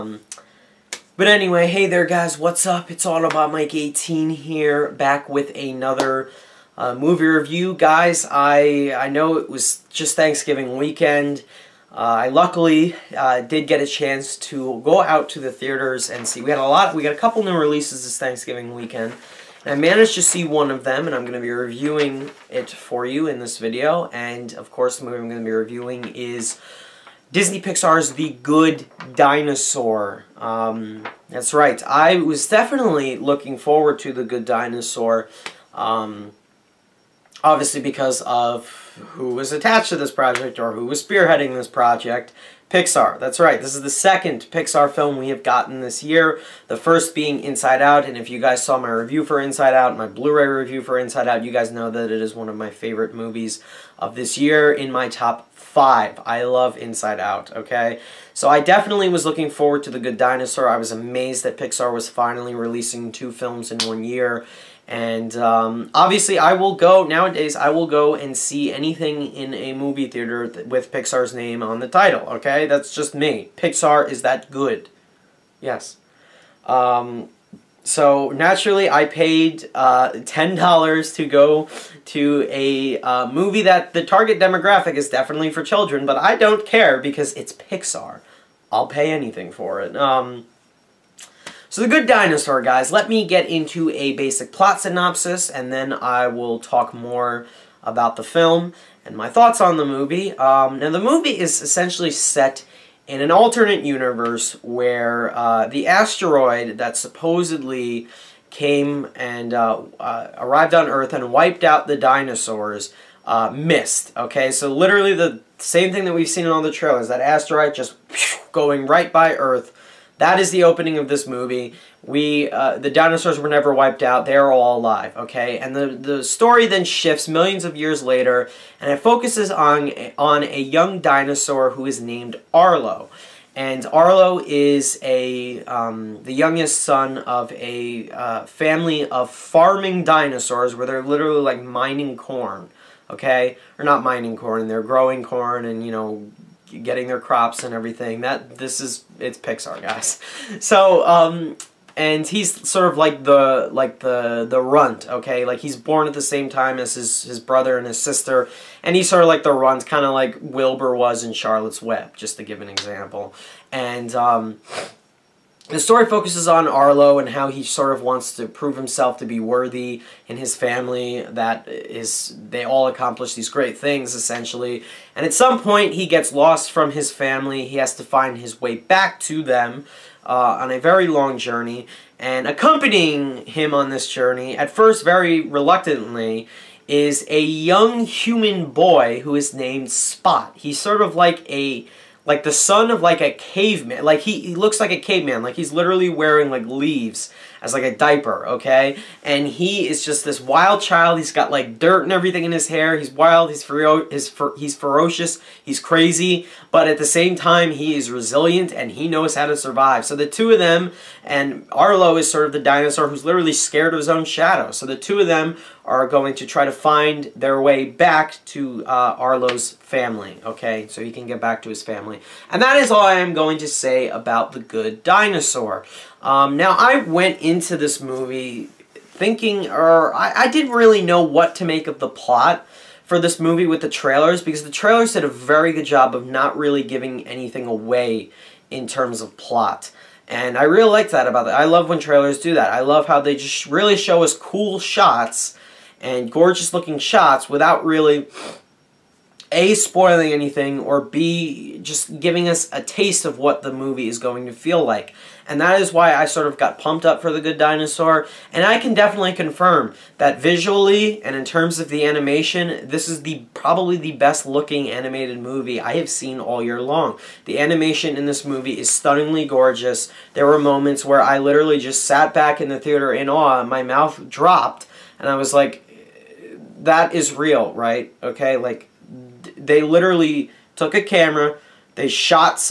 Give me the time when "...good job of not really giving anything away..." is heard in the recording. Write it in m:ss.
3:55.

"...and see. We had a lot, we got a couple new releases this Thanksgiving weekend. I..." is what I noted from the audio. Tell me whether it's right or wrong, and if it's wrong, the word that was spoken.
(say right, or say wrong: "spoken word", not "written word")
right.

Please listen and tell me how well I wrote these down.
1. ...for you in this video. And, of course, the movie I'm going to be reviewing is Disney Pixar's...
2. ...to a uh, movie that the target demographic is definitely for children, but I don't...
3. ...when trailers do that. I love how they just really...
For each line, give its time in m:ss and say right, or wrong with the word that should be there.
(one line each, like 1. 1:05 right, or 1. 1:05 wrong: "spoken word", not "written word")
1. 0:22 right
2. 1:22 right
3. 4:01 right.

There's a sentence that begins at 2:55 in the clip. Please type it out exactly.
And at some point, he gets lost from his family.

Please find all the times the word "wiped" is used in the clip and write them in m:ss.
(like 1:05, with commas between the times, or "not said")
1:51, 2:03.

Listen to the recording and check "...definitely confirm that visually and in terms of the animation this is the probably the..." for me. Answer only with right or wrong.
right.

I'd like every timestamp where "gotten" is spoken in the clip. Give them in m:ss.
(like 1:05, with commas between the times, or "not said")
0:45.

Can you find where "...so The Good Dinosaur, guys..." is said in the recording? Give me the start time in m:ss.
1:31.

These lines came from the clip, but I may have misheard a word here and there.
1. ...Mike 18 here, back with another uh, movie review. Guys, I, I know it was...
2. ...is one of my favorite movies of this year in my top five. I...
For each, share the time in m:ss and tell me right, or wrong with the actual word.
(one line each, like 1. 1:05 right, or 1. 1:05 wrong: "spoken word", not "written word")
1. 0:03 right
2. 0:52 right.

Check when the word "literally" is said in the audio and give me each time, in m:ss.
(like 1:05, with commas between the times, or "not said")
1:54, 2:21, 3:15, 3:33, 4:31, 4:39.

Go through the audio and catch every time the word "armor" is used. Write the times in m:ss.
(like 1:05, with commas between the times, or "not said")
not said.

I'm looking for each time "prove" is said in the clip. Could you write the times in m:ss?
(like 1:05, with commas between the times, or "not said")
2:48.